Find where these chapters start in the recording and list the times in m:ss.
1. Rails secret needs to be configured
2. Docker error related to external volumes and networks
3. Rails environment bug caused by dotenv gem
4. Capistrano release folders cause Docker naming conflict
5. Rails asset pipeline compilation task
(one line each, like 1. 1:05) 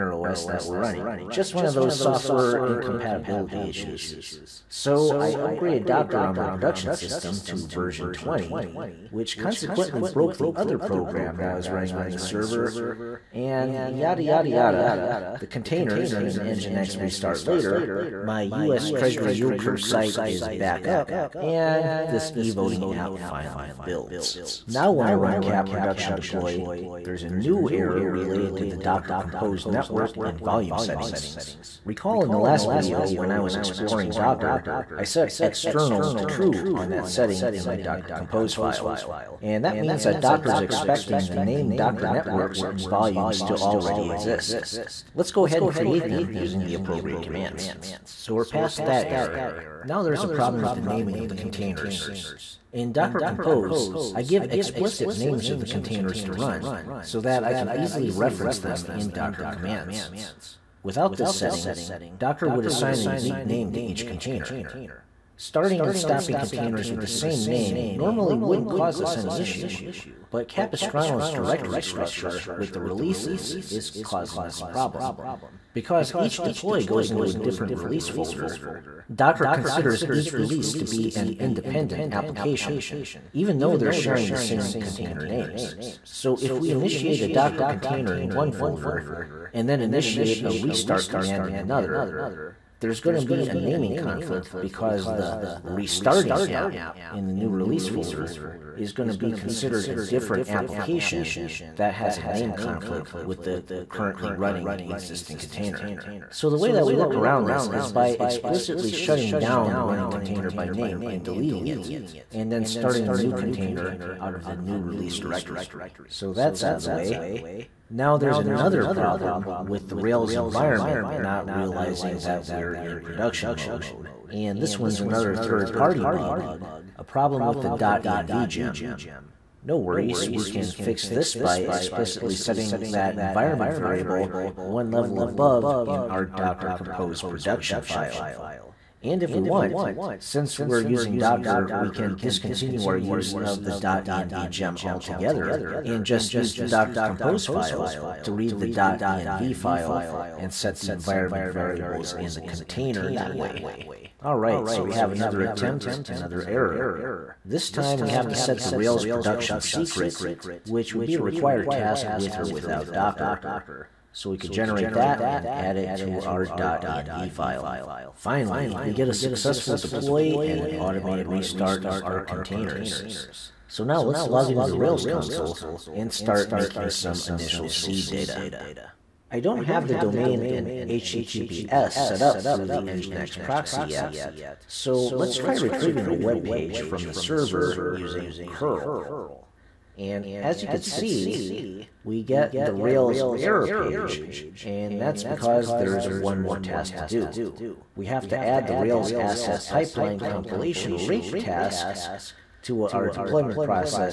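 1. 2:33
2. 0:24
3. 1:58
4. 0:47
5. 2:53.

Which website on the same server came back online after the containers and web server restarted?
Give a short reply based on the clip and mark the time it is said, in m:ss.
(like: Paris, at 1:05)
US Treasury yield curve site, at 0:18.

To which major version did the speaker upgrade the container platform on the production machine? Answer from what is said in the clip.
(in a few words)
20.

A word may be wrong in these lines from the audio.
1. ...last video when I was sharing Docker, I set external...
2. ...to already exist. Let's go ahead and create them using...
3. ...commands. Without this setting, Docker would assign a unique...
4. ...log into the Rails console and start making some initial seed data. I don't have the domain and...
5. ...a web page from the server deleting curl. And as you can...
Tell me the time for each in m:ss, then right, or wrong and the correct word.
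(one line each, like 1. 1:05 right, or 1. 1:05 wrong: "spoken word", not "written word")
1. 0:32 wrong: "exploring", not "sharing"
2. 0:43 right
3. 0:59 right
4. 2:54 right
5. 3:06 wrong: "using", not "deleting".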